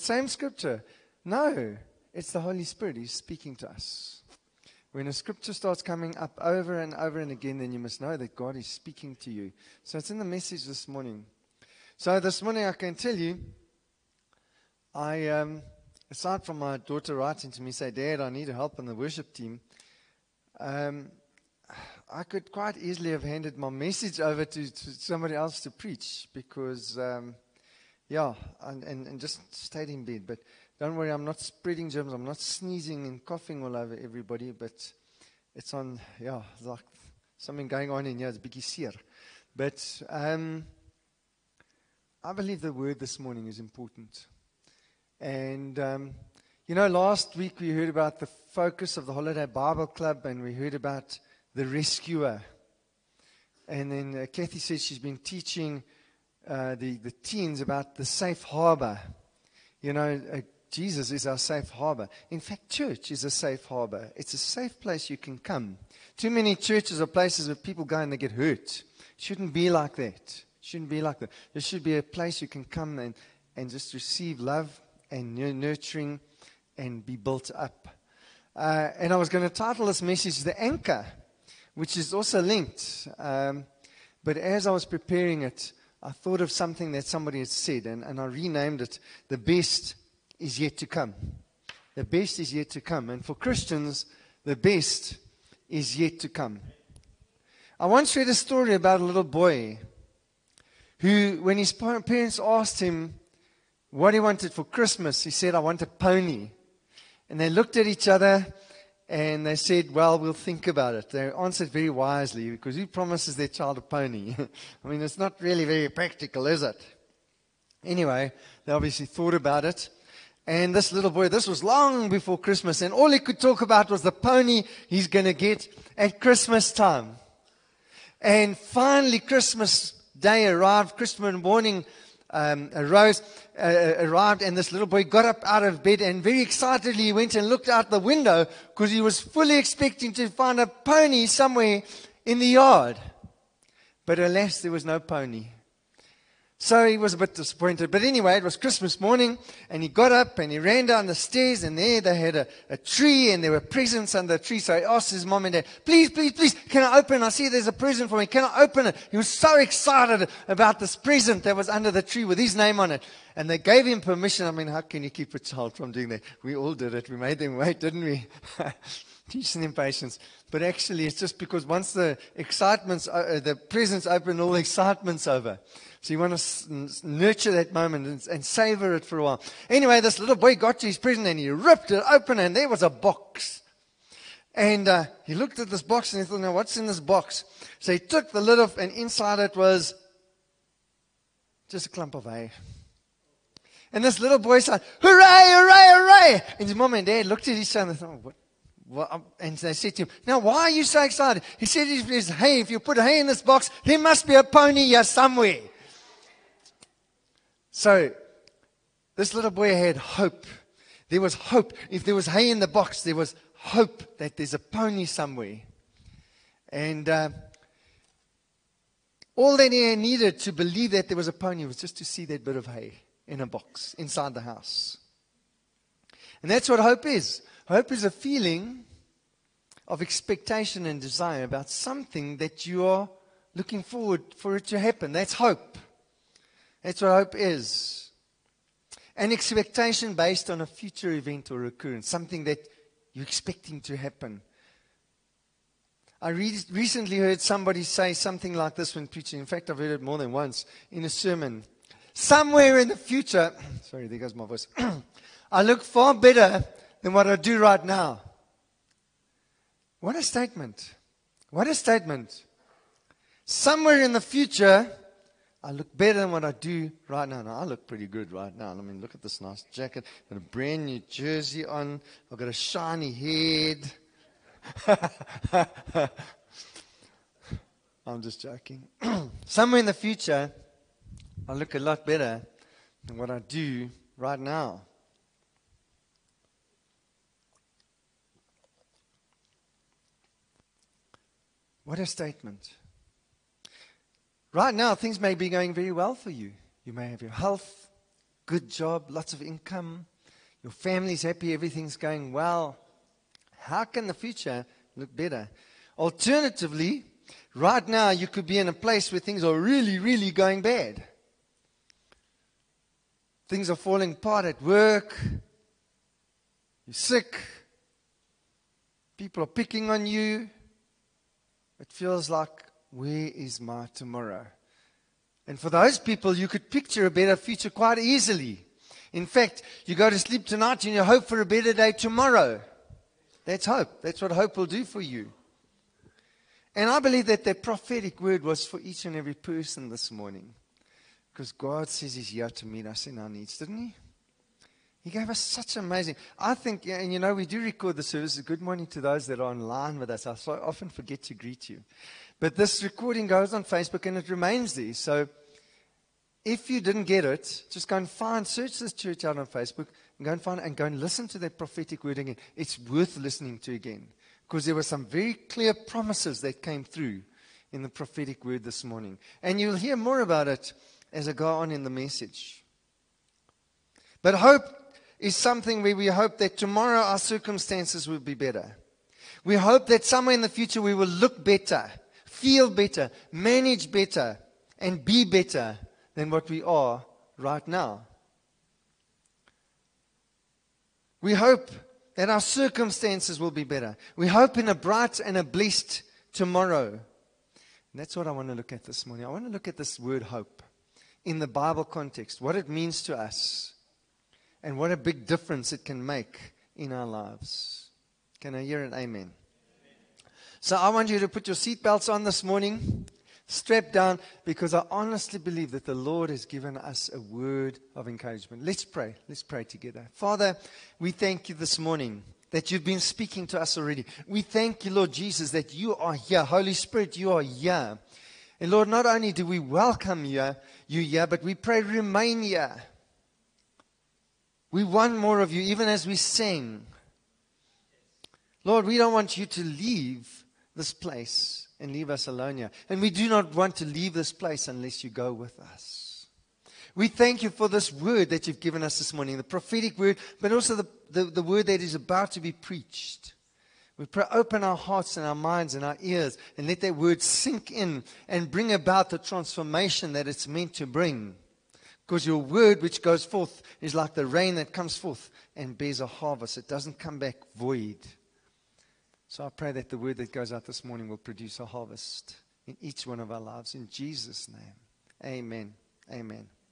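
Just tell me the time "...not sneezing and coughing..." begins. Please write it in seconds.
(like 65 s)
32 s.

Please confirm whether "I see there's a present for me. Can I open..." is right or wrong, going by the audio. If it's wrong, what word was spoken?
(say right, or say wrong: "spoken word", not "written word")
right.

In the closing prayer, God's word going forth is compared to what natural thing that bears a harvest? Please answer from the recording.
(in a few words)
The rain.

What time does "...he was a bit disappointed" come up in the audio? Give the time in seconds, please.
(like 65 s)
146 s.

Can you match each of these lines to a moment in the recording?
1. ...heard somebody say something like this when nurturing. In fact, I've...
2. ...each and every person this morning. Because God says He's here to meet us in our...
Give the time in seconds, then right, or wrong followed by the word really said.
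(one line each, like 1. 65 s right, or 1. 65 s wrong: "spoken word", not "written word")
1. 247 s wrong: "preaching", not "nurturing"
2. 338 s right.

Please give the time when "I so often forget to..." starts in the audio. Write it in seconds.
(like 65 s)
350 s.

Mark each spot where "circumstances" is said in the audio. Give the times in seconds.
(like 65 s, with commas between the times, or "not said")
377 s, 392 s.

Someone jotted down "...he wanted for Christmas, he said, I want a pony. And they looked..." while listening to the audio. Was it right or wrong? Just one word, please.
right.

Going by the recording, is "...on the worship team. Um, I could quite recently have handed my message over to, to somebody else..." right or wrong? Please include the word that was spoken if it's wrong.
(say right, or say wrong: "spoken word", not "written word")
wrong: "easily", not "recently".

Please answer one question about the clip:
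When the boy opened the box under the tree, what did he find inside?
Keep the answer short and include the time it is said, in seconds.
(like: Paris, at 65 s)
A clump of hay, at 191 s.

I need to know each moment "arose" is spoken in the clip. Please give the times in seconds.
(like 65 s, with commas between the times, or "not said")
132 s.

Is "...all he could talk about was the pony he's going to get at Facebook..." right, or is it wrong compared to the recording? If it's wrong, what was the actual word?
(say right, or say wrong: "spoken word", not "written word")
wrong: "Christmas", not "Facebook".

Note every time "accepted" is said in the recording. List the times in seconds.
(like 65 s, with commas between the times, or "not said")
not said.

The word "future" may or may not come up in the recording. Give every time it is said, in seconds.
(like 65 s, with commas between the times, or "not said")
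240 s, 252 s, 264 s, 279 s, 304 s, 327 s, 380 s.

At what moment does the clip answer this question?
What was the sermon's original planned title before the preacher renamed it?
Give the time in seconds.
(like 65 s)
80 s.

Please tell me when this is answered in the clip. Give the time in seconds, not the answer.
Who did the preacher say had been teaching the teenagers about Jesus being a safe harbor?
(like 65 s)
54 s.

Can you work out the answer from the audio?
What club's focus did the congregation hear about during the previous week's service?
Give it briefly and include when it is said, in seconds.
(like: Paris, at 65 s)
Holiday Bible Club, at 49 s.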